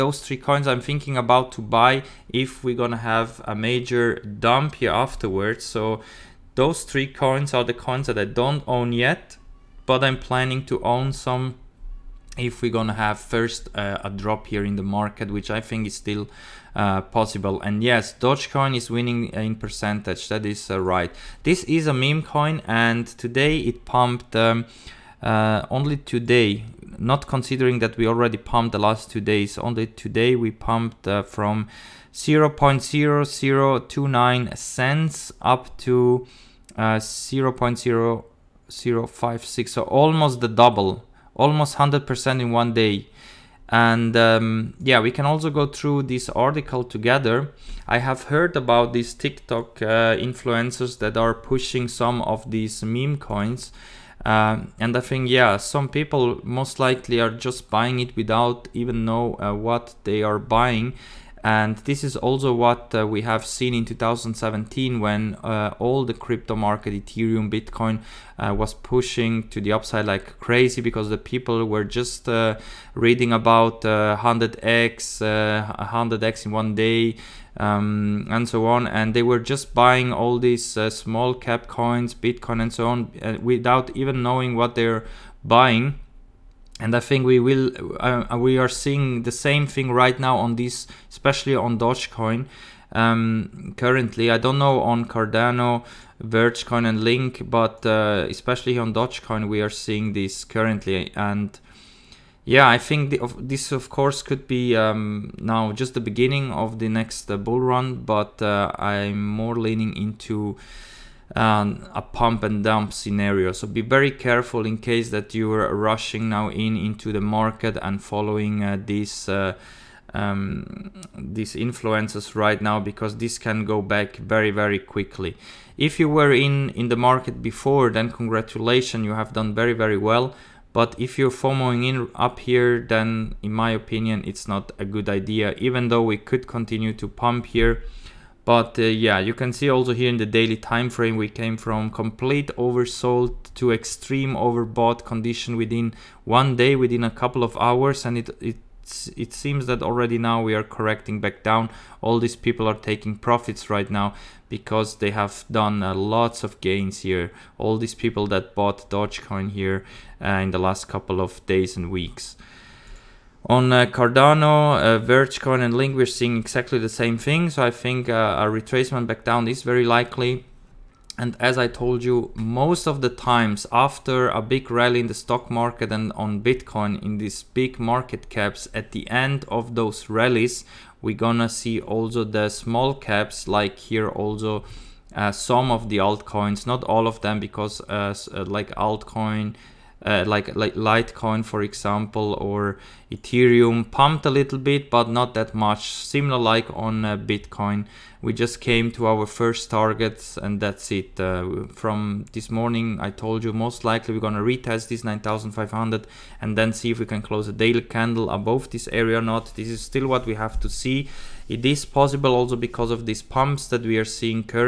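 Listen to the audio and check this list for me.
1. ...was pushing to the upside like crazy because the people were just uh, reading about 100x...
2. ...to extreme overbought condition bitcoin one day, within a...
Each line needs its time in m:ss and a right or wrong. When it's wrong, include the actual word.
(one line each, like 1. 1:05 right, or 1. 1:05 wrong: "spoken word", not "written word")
1. 1:08 right
2. 2:23 wrong: "within", not "bitcoin".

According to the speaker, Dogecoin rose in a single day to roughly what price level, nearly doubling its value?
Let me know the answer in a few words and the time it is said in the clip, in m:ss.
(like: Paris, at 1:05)
0.0056, at 0:36.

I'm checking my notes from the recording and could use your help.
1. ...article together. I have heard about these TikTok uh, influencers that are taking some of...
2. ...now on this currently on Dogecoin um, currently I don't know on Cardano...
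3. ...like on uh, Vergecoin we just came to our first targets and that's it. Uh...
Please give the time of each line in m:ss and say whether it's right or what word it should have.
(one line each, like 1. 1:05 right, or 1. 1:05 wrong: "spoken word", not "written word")
1. 0:46 wrong: "pushing", not "taking"
2. 1:30 wrong: "especially", not "currently"
3. 3:16 wrong: "Bitcoin", not "Vergecoin".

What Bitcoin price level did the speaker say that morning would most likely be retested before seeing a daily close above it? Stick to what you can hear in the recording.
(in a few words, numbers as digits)
9500.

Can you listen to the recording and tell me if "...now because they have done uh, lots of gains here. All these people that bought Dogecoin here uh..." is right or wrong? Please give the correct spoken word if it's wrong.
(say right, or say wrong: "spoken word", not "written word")
right.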